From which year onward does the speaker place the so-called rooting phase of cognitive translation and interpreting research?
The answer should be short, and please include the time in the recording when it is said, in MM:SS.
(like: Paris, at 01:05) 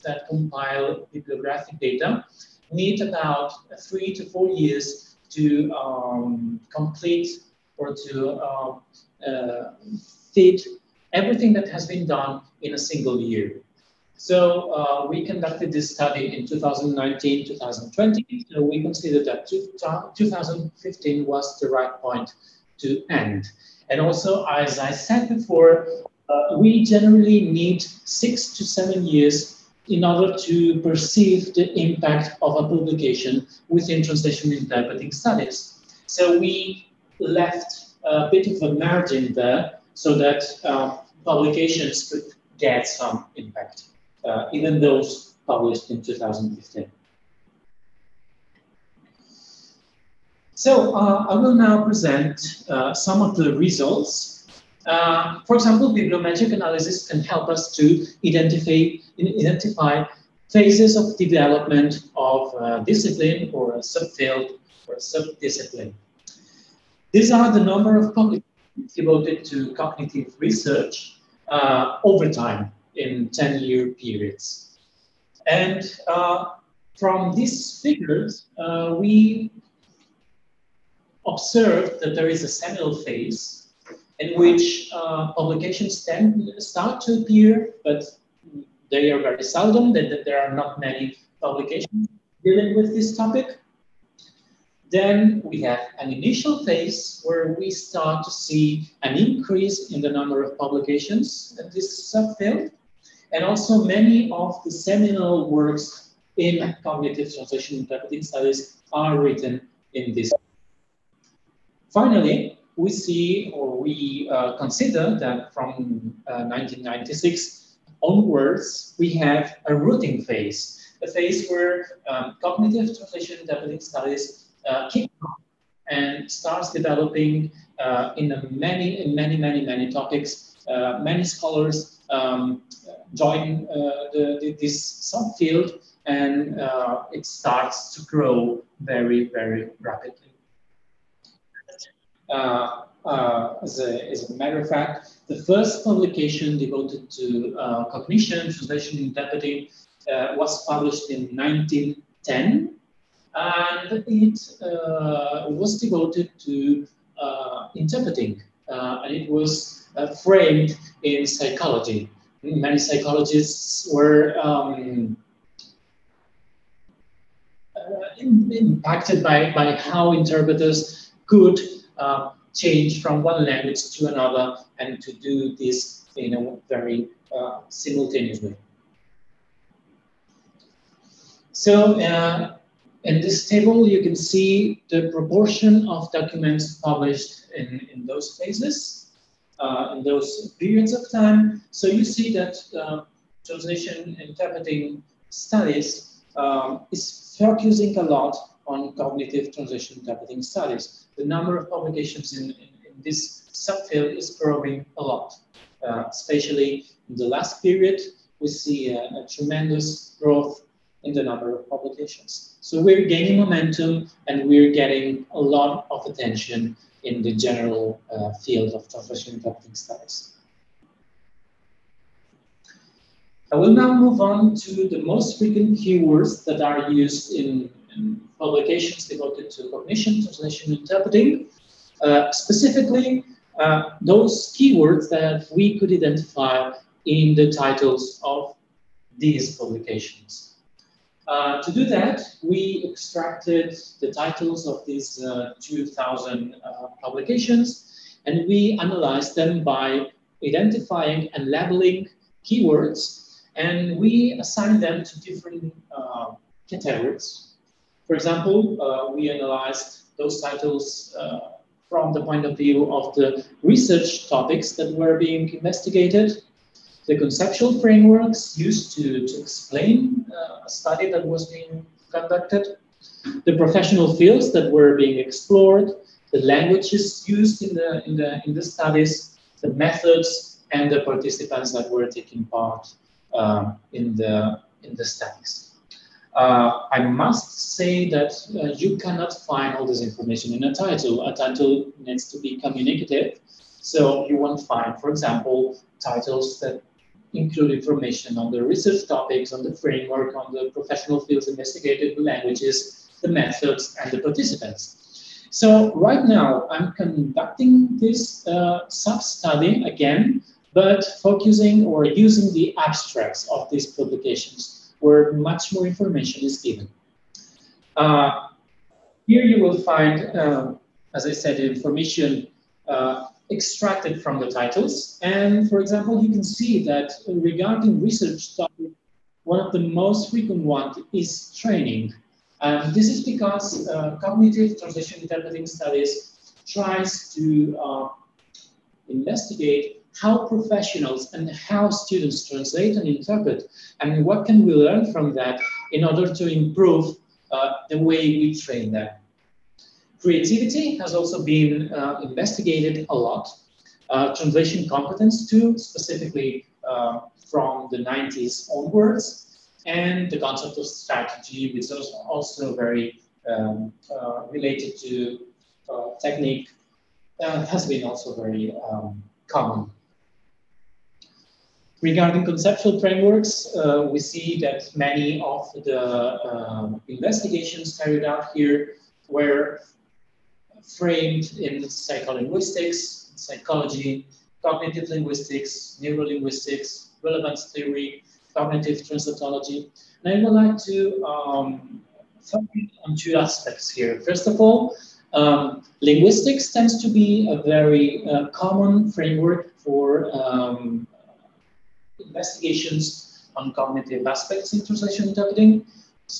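1996, at 01:56.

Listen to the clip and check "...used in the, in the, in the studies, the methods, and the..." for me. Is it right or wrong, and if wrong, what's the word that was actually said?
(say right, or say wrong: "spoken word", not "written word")
right.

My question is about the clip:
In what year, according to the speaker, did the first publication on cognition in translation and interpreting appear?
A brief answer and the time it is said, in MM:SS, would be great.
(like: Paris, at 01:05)
1910, at 02:31.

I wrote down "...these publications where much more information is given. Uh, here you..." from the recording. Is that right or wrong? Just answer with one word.
right.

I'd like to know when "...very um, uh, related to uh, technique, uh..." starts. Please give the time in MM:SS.
06:02.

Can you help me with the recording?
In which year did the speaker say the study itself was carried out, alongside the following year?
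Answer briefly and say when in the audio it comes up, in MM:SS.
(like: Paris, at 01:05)
2019, at 00:16.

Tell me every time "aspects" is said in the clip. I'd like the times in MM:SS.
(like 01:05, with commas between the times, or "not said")
06:33, 06:44.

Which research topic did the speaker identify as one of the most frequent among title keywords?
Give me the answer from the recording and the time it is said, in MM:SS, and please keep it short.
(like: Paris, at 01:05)
Training, at 05:31.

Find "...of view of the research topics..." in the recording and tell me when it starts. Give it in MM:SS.
04:22.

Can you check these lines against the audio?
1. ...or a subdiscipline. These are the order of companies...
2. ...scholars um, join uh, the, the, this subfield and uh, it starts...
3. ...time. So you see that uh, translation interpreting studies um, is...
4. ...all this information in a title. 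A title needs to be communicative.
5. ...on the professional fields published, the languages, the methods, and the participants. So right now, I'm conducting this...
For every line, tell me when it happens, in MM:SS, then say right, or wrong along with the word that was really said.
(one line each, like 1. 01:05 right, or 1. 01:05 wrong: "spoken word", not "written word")
1. 01:04 wrong: "number", not "order"
2. 02:11 right
3. 03:11 right
4. 04:49 right
5. 05:00 wrong: "investigated", not "published".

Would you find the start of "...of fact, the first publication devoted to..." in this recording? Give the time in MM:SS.
02:24.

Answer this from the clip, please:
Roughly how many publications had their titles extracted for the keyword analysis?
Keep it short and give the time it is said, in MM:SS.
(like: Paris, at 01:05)
2,000, at 04:05.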